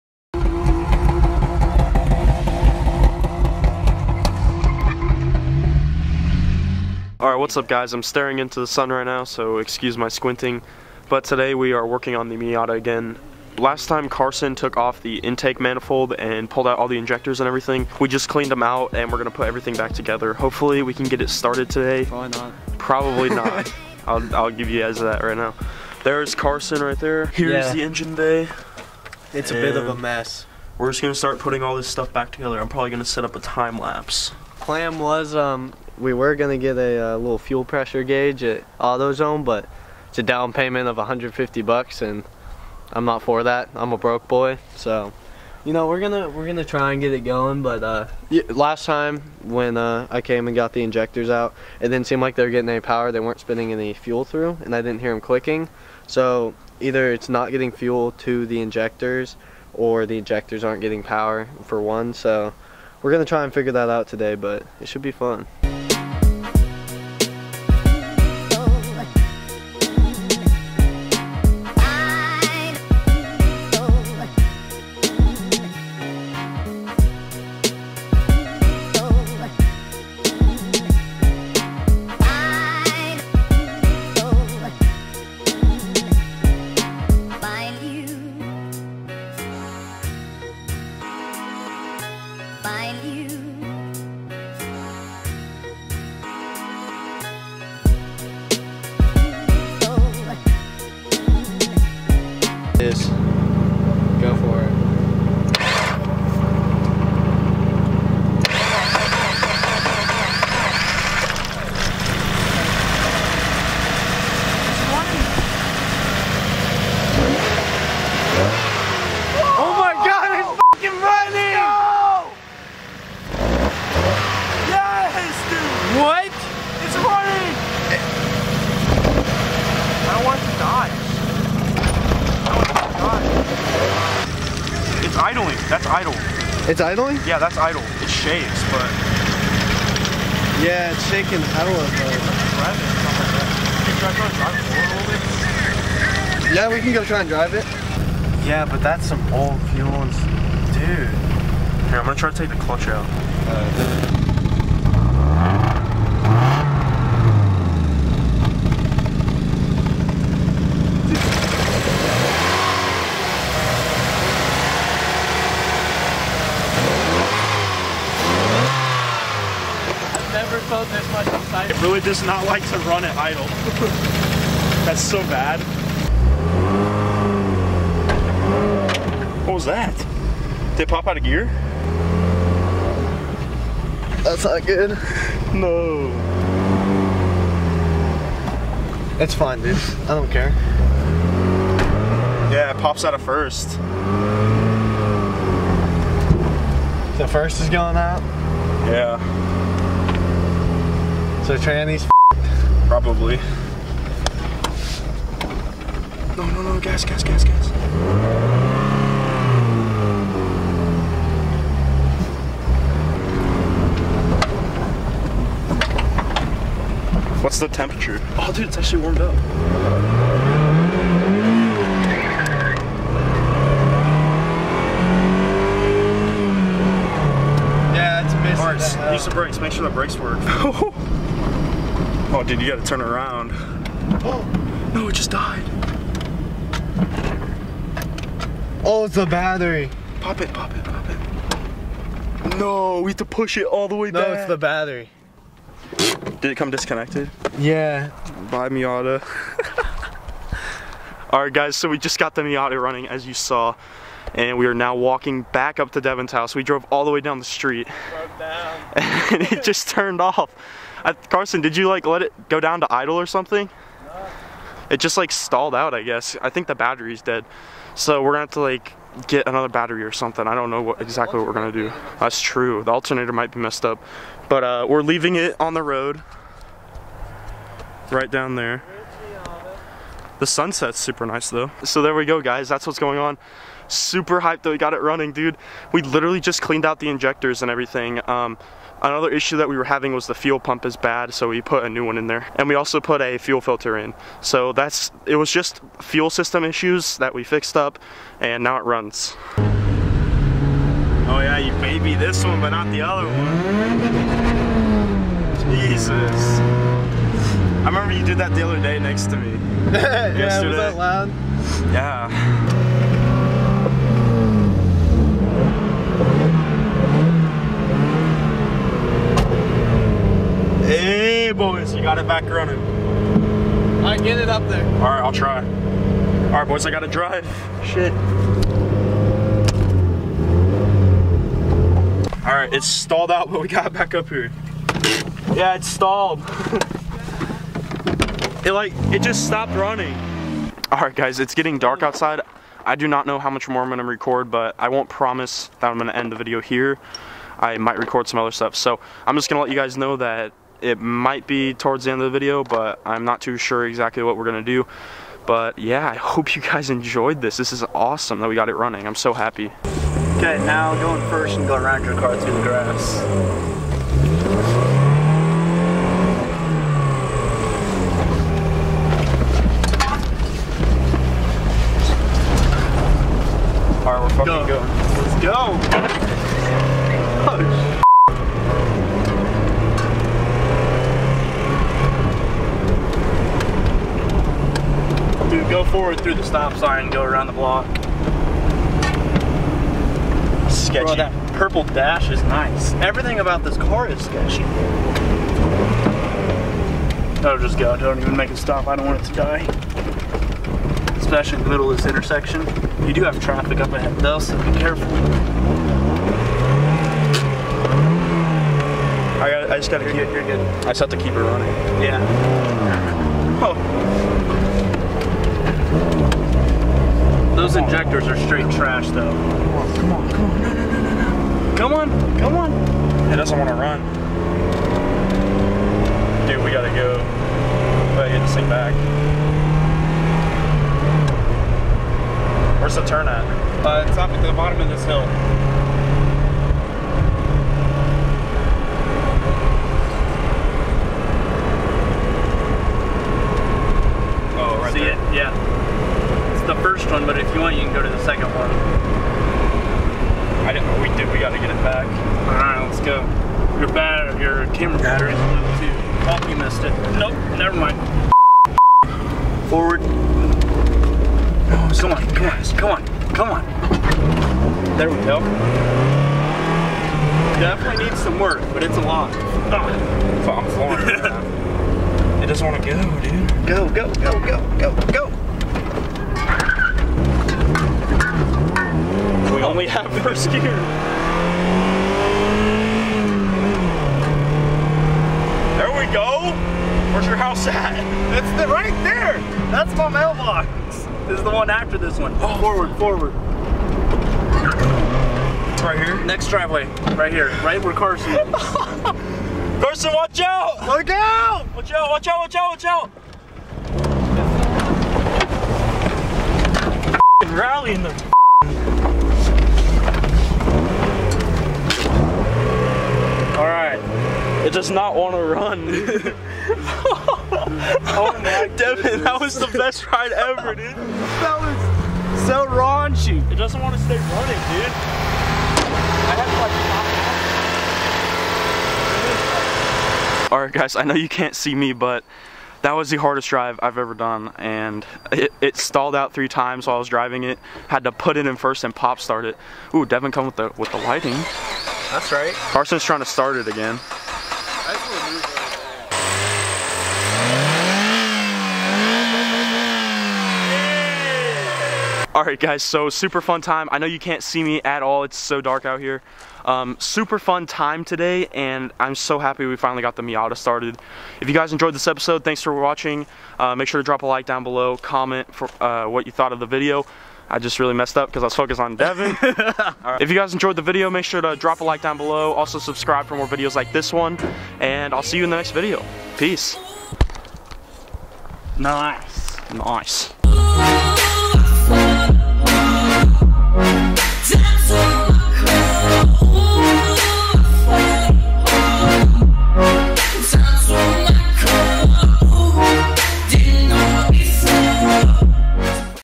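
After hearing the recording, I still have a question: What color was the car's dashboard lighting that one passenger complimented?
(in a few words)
Purple.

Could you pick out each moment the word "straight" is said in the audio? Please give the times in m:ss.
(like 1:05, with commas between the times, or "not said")
6:58.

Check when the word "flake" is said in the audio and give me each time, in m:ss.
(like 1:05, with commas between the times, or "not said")
not said.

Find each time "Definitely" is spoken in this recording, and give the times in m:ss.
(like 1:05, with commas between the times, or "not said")
7:47.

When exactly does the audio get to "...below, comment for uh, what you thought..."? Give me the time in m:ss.
9:24.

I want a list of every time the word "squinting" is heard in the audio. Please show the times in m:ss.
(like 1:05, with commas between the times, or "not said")
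0:10.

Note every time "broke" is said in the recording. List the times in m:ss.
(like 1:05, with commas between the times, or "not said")
0:43.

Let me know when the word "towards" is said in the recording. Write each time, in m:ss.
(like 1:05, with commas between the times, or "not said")
5:51.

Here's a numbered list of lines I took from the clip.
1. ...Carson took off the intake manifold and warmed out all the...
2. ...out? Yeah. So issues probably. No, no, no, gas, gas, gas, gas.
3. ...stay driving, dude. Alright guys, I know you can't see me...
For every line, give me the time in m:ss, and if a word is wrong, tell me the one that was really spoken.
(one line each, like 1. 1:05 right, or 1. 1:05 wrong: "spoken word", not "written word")
1. 0:14 wrong: "pulled", not "warmed"
2. 3:17 wrong: "trannies", not "issues"
3. 8:44 wrong: "running", not "driving".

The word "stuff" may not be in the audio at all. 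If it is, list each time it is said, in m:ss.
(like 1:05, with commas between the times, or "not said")
0:31, 5:48.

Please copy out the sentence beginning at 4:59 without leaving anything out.
Oh yeah, you baby this one, but not the other one.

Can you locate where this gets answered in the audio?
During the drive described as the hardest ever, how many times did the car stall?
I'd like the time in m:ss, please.
8:56.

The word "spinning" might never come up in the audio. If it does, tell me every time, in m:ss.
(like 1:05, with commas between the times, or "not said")
0:53.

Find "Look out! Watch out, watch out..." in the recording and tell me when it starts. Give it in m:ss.
8:20.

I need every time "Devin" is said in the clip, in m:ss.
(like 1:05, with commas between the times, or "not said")
4:16, 8:38, 9:00, 9:28.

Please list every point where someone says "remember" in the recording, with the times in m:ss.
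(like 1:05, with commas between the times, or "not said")
5:07.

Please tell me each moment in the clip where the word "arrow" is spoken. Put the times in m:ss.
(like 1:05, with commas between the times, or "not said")
not said.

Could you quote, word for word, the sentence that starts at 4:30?
I don't know what exactly what we're gonna do.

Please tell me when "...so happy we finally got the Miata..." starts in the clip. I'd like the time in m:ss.
9:19.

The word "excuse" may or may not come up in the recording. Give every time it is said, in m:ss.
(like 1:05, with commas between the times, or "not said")
0:09.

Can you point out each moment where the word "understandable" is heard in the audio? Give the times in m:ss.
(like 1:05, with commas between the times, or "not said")
not said.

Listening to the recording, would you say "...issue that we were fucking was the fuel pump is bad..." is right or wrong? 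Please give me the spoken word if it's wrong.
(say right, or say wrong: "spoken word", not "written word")
wrong: "having", not "fucking".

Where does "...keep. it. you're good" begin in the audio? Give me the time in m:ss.
6:50.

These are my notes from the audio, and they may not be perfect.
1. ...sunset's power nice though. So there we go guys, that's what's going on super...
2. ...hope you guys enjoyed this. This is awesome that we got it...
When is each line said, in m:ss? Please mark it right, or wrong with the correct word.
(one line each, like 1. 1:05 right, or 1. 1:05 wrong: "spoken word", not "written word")
1. 4:40 wrong: "super", not "power"
2. 5:56 right.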